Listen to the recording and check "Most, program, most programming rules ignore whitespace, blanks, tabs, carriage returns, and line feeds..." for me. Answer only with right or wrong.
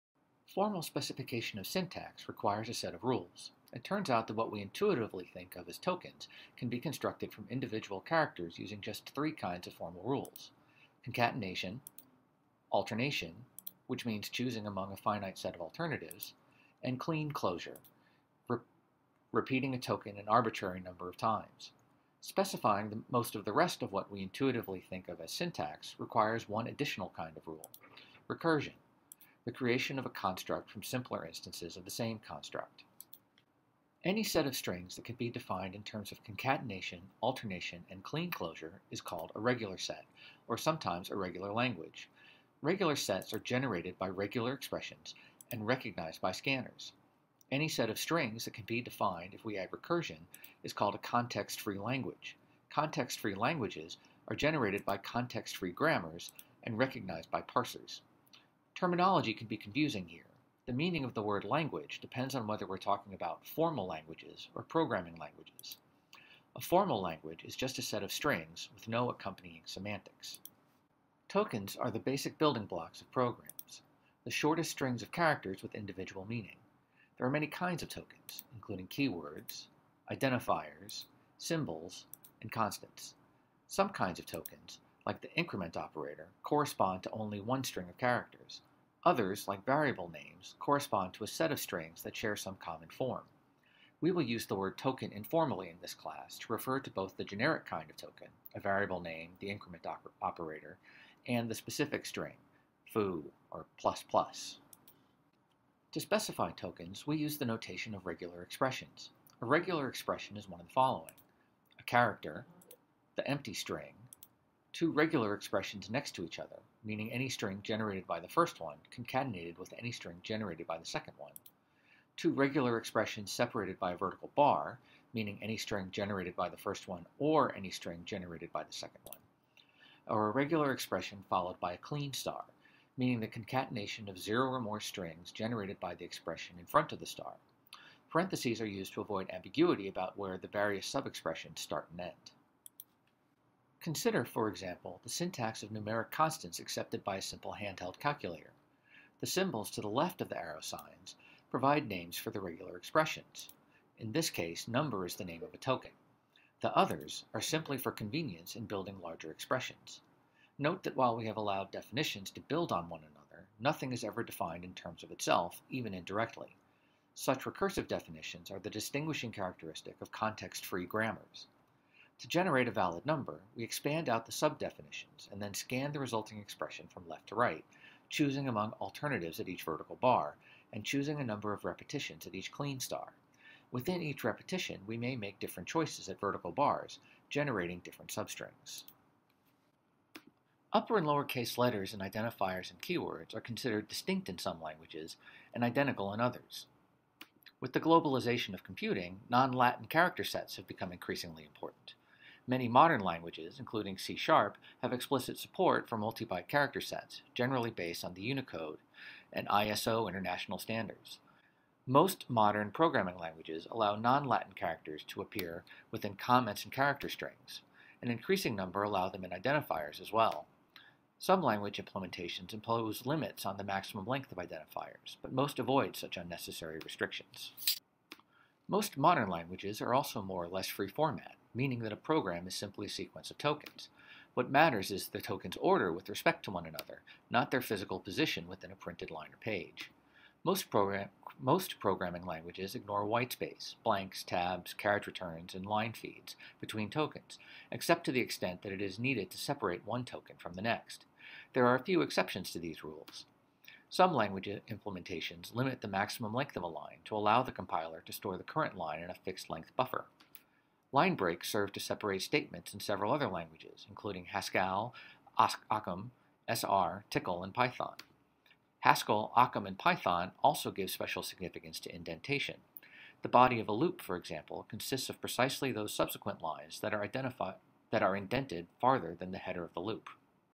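wrong.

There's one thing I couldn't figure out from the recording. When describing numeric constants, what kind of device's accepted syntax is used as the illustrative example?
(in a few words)
handheld calculator.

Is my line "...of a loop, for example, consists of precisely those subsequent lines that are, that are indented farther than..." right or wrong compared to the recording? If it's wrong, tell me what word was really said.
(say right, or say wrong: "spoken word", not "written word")
right.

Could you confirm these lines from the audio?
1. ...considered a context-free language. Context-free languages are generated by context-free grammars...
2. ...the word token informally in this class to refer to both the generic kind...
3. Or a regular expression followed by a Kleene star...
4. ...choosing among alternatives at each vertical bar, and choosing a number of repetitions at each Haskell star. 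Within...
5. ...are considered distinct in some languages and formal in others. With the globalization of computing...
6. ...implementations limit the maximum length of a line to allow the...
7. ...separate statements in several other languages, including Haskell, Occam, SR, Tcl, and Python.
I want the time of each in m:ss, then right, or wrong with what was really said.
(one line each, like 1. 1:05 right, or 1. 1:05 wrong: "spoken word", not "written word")
1. 0:50 wrong: "called", not "considered"
2. 1:34 right
3. 2:10 right
4. 2:58 wrong: "Kleene", not "Haskell"
5. 3:13 wrong: "identical", not "formal"
6. 4:14 right
7. 4:21 right.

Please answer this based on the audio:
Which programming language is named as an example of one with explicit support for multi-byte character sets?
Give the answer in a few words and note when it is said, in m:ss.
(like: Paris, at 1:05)
C#, at 3:23.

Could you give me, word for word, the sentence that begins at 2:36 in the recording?
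The others are simply for convenience in building larger expressions.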